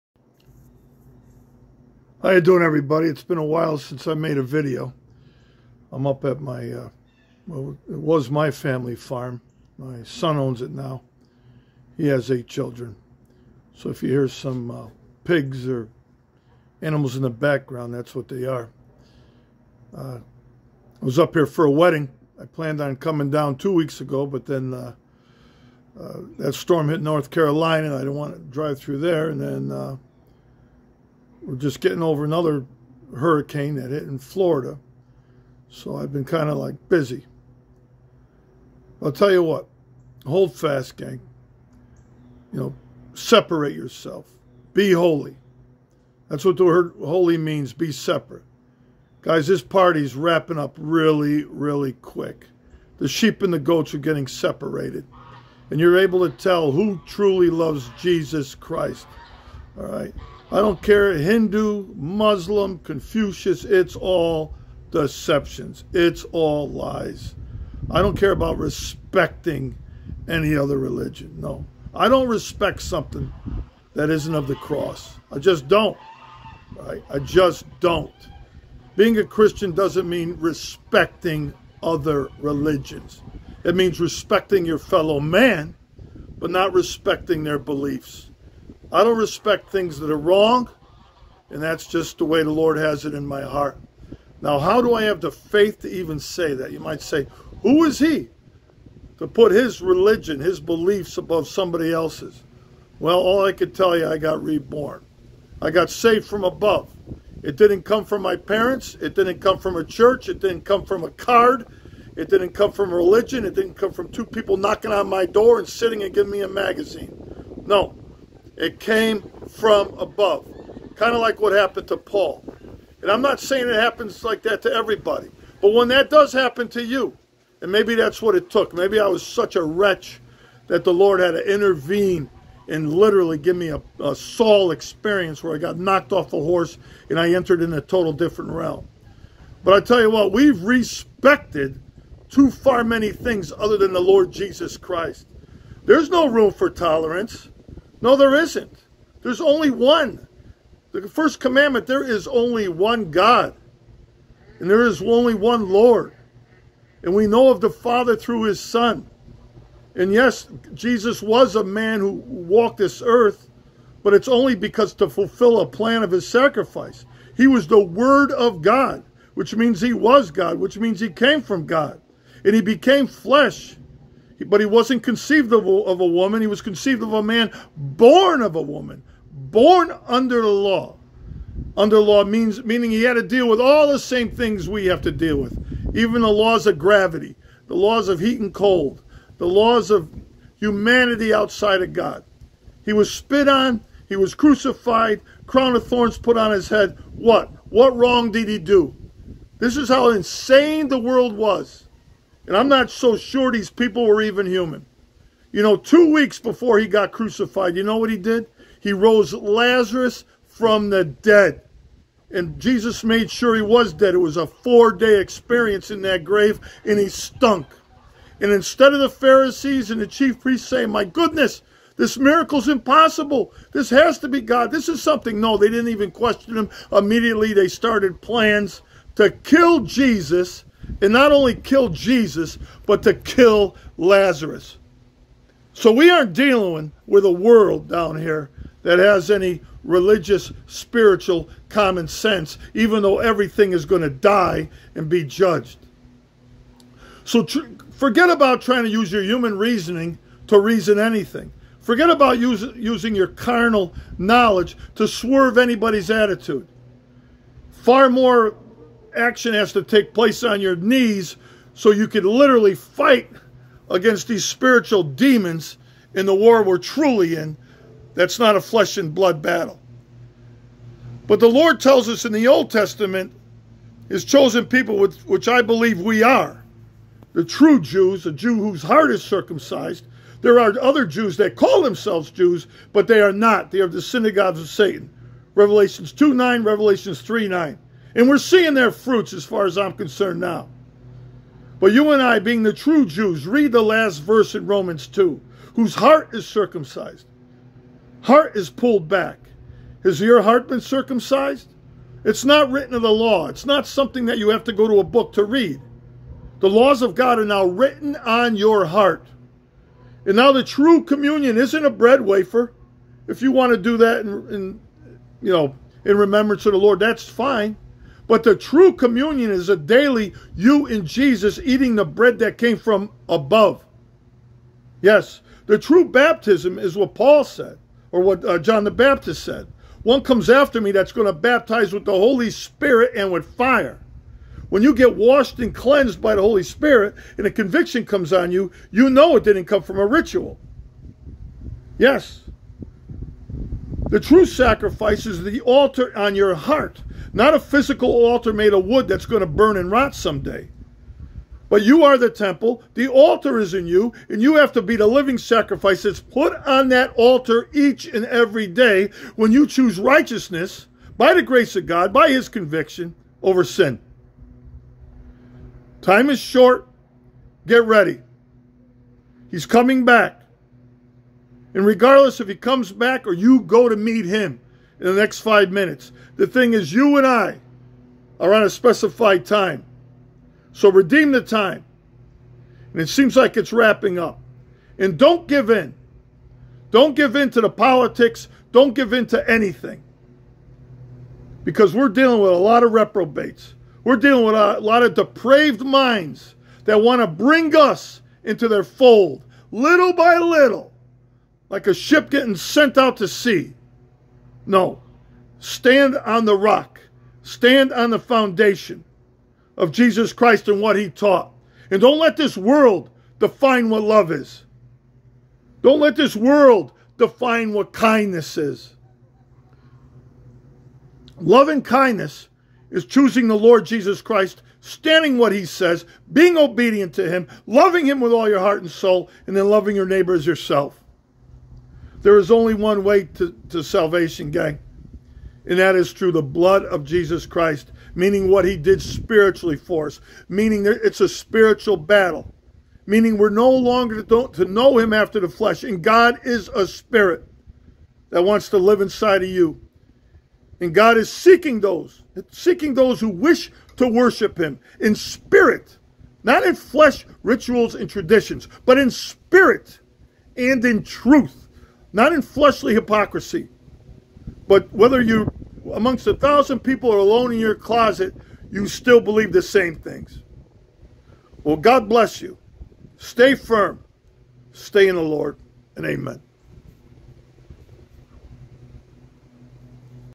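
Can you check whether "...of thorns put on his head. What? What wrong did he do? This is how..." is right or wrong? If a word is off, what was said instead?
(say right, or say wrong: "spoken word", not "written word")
right.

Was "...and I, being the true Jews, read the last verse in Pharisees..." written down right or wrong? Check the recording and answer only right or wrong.
wrong.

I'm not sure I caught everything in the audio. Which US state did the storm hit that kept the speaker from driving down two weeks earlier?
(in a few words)
North Carolina.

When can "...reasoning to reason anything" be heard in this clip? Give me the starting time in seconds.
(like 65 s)
249 s.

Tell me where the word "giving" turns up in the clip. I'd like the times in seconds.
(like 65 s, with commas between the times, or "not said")
116 s.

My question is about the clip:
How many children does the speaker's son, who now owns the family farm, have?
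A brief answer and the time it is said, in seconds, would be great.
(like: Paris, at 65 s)
8, at 12 s.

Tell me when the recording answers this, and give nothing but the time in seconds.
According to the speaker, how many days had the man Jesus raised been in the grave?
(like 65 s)
214 s.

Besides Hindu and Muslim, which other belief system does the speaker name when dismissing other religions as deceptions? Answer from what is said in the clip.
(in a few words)
Confucius.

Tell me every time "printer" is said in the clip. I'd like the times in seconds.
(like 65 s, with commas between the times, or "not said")
not said.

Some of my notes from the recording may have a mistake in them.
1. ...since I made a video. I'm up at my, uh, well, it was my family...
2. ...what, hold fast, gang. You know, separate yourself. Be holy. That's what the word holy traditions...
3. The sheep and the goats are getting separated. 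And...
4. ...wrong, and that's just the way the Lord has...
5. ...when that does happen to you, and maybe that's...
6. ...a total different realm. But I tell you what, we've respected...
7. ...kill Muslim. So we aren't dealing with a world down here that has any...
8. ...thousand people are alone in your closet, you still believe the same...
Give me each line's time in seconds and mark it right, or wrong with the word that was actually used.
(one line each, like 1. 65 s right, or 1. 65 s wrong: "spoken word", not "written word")
1. 3 s right
2. 39 s wrong: "means", not "traditions"
3. 52 s right
4. 90 s right
5. 125 s right
6. 137 s right
7. 233 s wrong: "Lazarus", not "Muslim"
8. 466 s right.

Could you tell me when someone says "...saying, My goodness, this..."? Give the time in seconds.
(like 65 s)
220 s.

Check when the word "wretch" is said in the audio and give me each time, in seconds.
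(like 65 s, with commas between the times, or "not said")
129 s.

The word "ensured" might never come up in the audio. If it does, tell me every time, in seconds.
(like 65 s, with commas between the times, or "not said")
not said.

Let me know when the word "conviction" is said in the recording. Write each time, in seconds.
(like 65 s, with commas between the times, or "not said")
337 s, 362 s.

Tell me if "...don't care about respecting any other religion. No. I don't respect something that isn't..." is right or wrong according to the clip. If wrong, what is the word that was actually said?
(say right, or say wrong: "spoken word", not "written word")
right.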